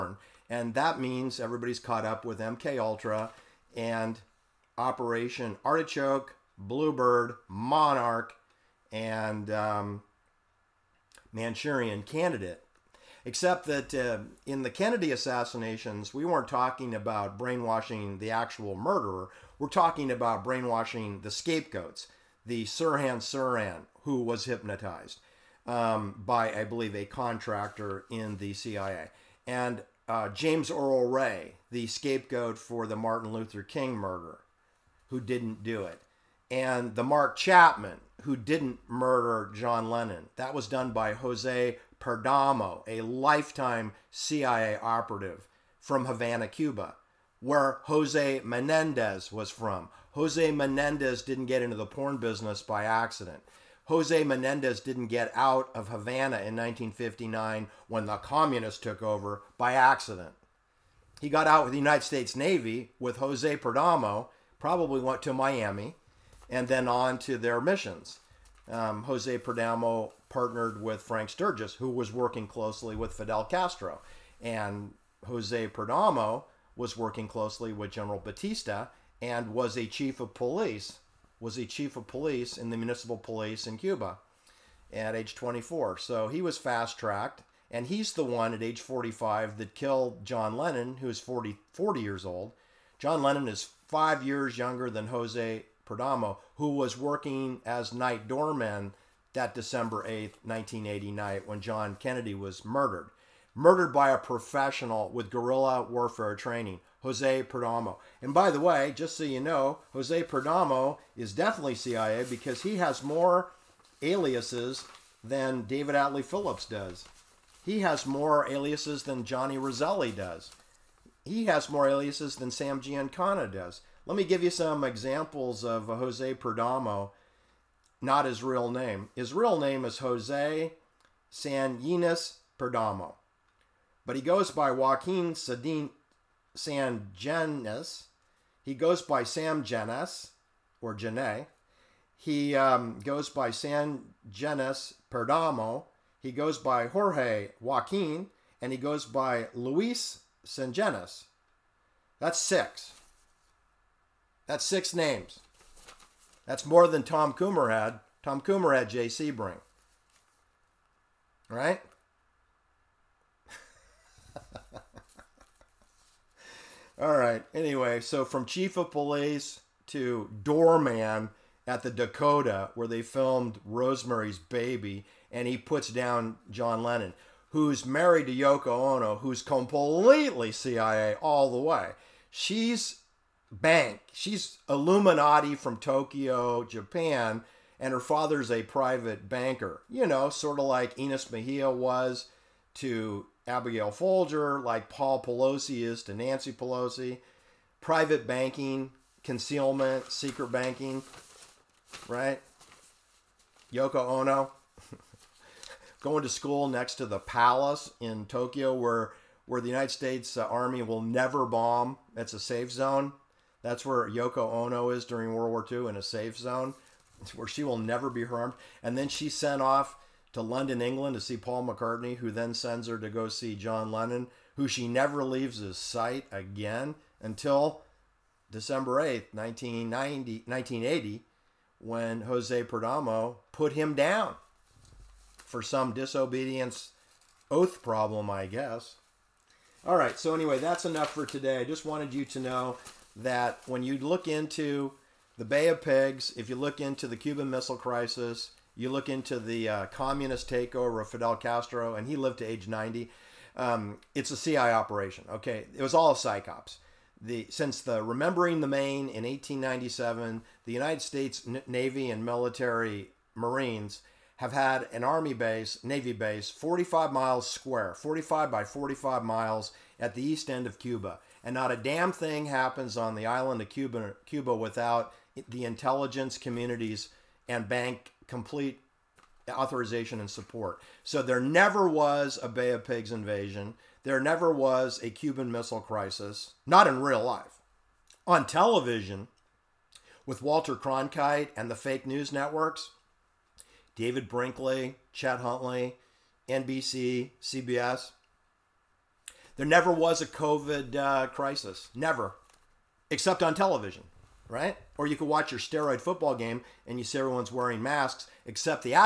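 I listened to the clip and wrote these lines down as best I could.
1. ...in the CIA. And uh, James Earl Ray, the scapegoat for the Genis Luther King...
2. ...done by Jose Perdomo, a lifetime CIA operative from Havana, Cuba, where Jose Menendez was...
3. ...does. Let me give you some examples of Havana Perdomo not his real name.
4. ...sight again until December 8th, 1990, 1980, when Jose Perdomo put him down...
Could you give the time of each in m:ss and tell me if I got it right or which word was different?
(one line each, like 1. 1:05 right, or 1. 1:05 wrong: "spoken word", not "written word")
1. 0:28 wrong: "Martin", not "Genis"
2. 0:40 right
3. 2:03 wrong: "Jose", not "Havana"
4. 3:45 right.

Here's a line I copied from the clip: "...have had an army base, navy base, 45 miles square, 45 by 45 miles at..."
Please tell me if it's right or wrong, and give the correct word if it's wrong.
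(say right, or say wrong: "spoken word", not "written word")
right.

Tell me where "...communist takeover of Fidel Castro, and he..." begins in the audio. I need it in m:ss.
4:09.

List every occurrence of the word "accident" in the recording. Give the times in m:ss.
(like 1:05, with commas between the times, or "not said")
0:52, 0:59.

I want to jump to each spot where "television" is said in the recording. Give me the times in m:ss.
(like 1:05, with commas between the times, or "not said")
4:48, 5:03.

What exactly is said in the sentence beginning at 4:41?
So there never was a Bay of Pigs invasion.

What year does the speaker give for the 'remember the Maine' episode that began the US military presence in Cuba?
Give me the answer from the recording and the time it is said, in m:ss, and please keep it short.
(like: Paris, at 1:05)
1897, at 4:19.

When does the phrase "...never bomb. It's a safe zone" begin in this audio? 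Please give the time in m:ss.
3:31.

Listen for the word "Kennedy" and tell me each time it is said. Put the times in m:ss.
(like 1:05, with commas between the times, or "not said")
0:14, 1:41.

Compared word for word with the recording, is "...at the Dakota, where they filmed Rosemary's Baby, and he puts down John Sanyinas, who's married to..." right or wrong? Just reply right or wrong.
wrong.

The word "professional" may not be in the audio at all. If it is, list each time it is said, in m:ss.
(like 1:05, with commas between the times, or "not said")
1:44.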